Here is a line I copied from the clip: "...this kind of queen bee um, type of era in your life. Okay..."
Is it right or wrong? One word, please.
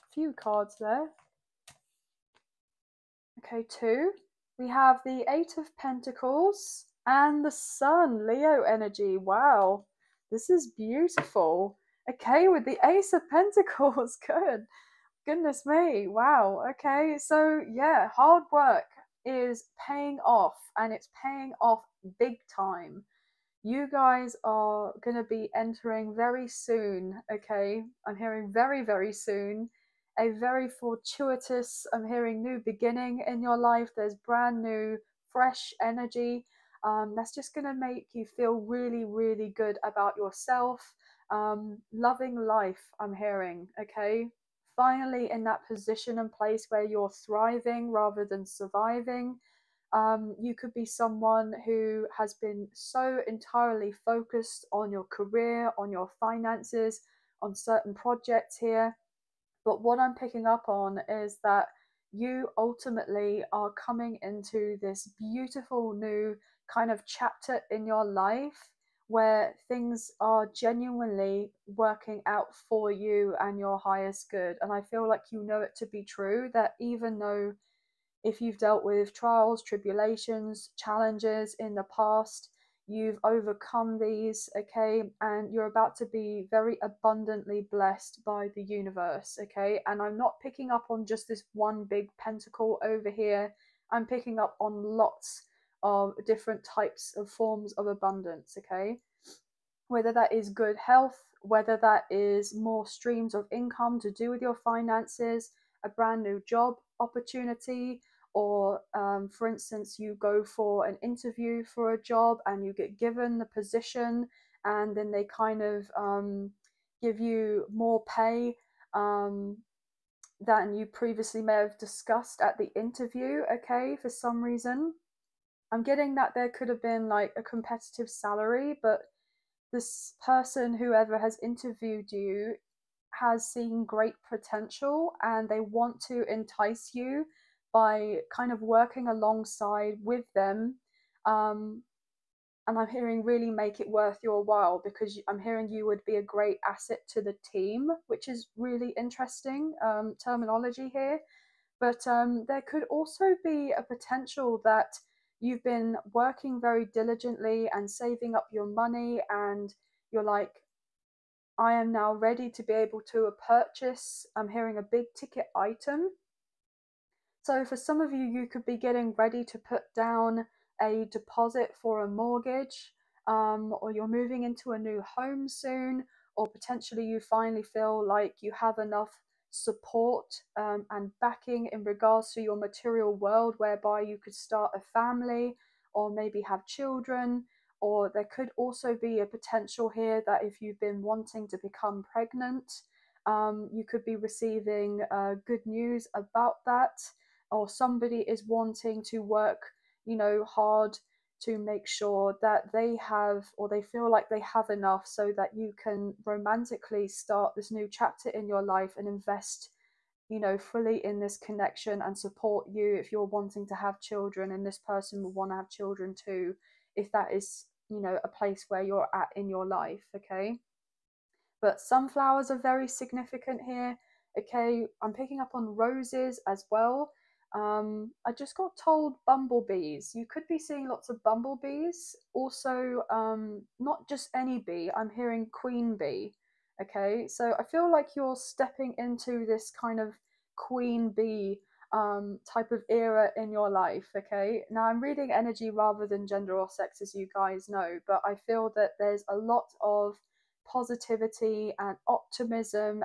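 right.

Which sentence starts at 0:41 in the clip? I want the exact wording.
Um, loving life, I'm hearing, okay?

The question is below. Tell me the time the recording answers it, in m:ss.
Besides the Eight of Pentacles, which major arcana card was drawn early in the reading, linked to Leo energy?
0:07.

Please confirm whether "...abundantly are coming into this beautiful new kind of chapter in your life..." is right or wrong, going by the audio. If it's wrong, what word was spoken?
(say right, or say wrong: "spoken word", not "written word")
wrong: "ultimately", not "abundantly".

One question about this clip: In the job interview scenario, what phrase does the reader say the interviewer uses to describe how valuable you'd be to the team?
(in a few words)
a great asset.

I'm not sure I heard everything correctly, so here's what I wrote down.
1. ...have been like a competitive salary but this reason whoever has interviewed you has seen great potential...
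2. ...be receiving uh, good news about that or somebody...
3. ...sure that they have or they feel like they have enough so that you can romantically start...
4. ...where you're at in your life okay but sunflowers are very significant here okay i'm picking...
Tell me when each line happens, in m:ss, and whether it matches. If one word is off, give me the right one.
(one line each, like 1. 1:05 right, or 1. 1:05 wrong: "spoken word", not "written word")
1. 2:06 wrong: "person", not "reason"
2. 3:14 right
3. 3:21 right
4. 3:38 right.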